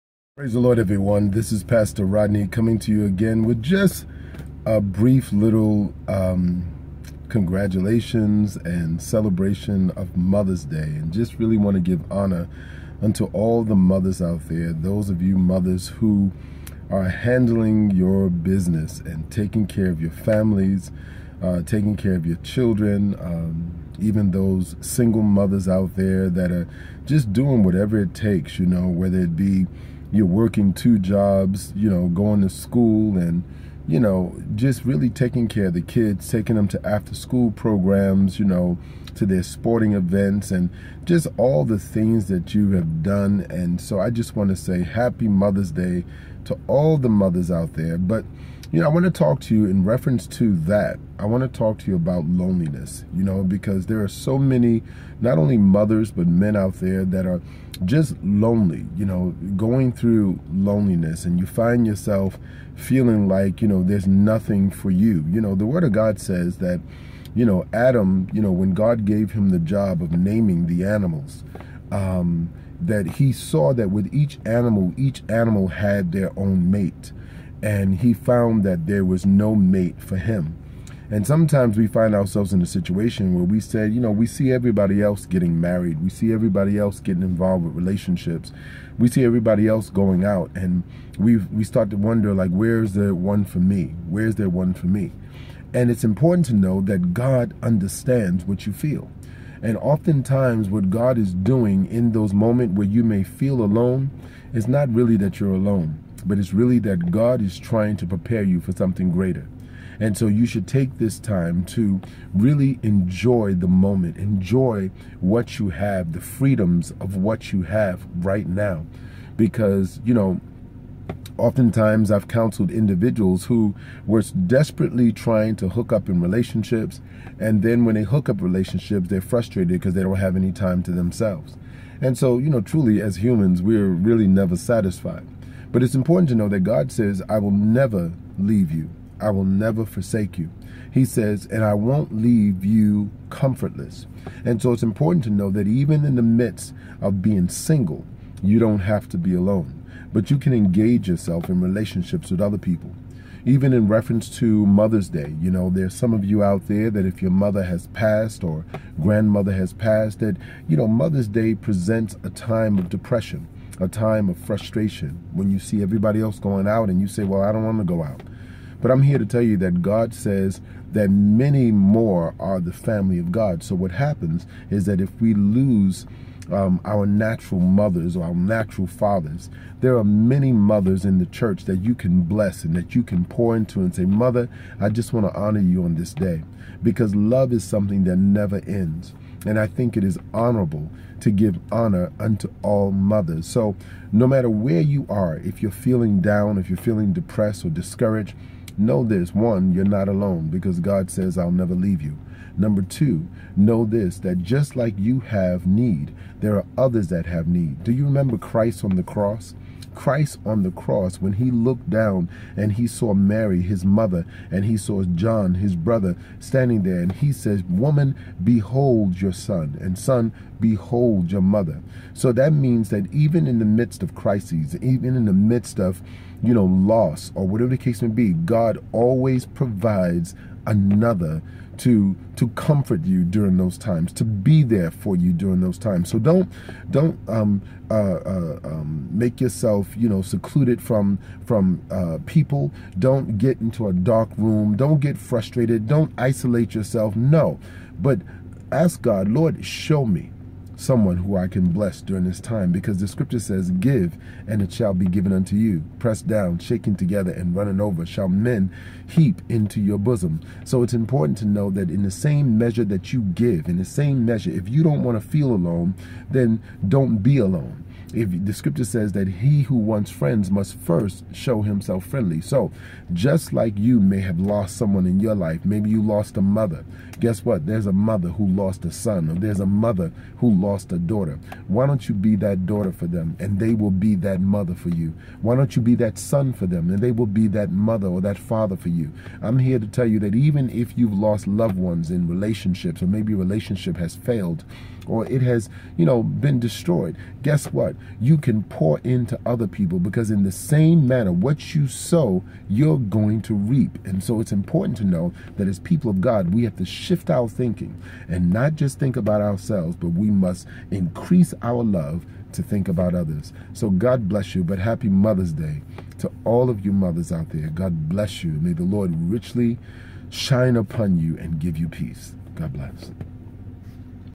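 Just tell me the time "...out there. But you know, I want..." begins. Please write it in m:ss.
0:47.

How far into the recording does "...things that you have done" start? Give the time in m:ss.
0:41.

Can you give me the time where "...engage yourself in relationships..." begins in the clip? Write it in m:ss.
2:30.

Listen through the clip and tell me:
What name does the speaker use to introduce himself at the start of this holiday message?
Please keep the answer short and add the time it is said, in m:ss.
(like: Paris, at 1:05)
Pastor Rodney, at 0:01.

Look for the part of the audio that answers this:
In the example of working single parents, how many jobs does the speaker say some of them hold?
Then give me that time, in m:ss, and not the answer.
0:30.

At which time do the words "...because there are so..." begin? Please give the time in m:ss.
0:53.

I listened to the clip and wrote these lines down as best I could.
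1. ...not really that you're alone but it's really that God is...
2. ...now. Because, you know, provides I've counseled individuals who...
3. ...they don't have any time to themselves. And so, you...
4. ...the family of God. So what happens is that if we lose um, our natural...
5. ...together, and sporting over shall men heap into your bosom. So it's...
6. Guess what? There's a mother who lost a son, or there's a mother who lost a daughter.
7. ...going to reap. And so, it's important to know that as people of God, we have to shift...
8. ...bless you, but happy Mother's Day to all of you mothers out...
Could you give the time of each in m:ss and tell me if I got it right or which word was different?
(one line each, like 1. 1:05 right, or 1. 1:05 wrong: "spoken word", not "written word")
1. 1:44 right
2. 1:58 wrong: "oftentimes", not "provides"
3. 2:09 right
4. 2:52 right
5. 4:16 wrong: "running", not "sporting"
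6. 4:37 right
7. 5:02 right
8. 5:14 right.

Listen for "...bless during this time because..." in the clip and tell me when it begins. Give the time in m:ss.
4:11.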